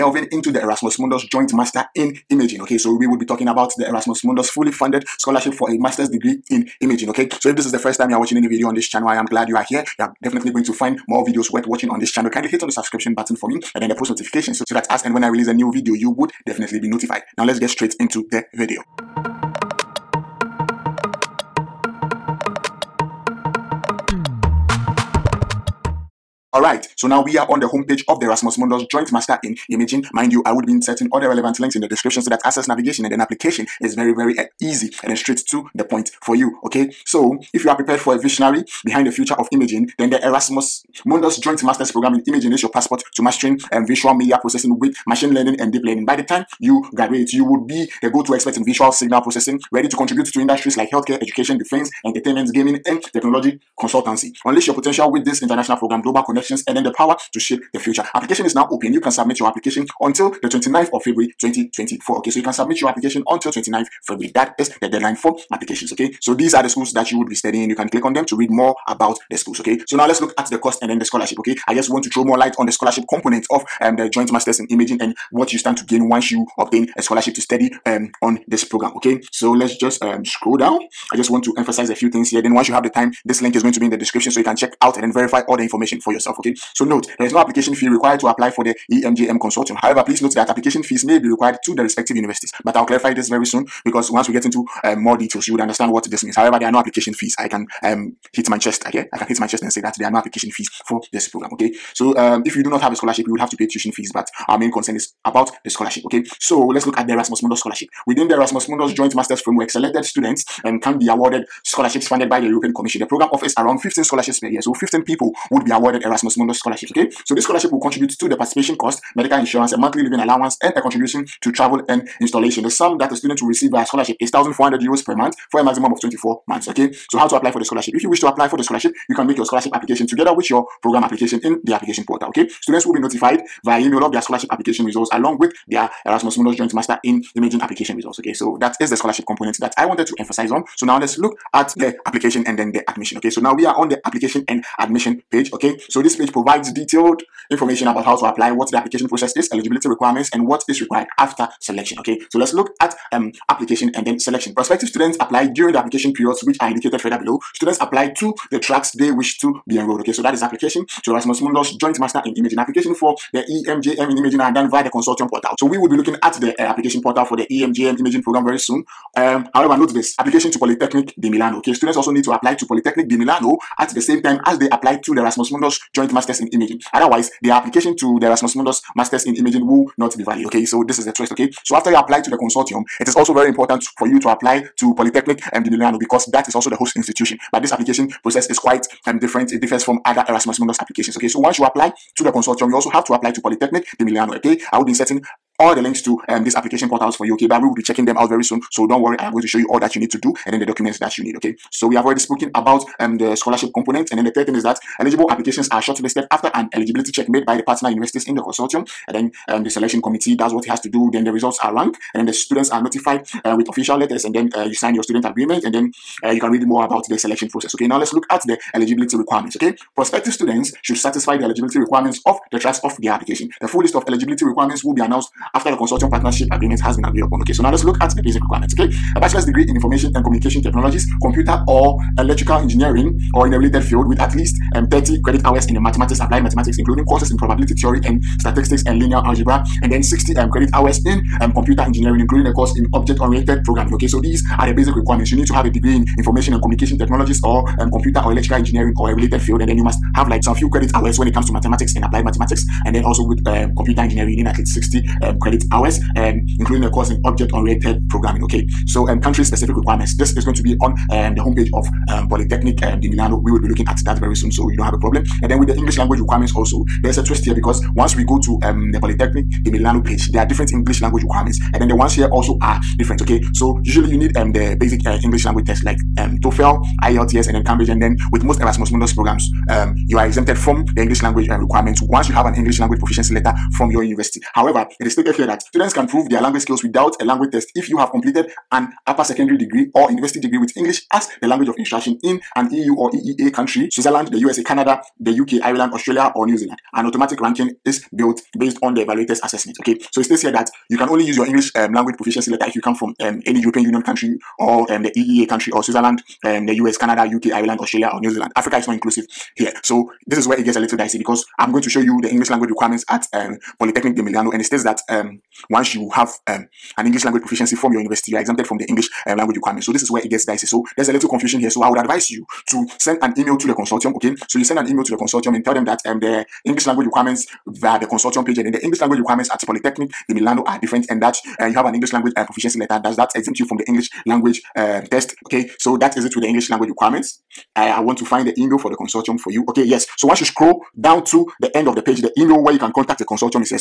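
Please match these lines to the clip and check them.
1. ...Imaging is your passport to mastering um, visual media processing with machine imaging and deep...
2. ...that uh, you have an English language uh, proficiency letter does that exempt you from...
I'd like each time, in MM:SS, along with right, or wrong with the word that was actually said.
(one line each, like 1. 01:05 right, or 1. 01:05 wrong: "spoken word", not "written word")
1. 00:42 wrong: "learning", not "imaging"
2. 05:31 right.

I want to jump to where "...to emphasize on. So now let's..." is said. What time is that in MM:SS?
02:20.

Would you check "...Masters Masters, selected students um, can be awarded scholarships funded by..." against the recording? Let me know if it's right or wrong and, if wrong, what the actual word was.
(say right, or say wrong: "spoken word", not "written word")
wrong: "Framework", not "Masters".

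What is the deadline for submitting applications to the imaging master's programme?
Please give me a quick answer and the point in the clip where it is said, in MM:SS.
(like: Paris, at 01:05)
29th of February 2024, at 01:00.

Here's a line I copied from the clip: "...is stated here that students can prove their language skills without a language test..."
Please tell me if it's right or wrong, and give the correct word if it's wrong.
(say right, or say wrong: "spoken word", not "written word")
right.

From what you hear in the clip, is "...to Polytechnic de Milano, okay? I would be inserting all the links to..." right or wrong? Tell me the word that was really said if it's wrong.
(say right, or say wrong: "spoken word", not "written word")
right.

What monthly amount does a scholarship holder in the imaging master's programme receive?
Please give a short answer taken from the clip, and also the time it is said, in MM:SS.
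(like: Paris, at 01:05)
1,400 euros, at 02:04.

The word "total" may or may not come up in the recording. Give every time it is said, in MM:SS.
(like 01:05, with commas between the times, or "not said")
not said.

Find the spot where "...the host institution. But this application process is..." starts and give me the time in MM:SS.
03:06.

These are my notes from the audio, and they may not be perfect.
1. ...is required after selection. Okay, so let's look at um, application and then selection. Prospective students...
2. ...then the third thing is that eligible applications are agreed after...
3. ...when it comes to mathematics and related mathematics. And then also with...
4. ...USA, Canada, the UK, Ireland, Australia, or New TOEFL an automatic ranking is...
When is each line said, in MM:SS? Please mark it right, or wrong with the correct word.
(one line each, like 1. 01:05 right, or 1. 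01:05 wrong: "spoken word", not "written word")
1. 02:30 right
2. 03:24 wrong: "shortlisted", not "agreed"
3. 04:11 wrong: "applied", not "related"
4. 04:54 wrong: "Zealand", not "TOEFL".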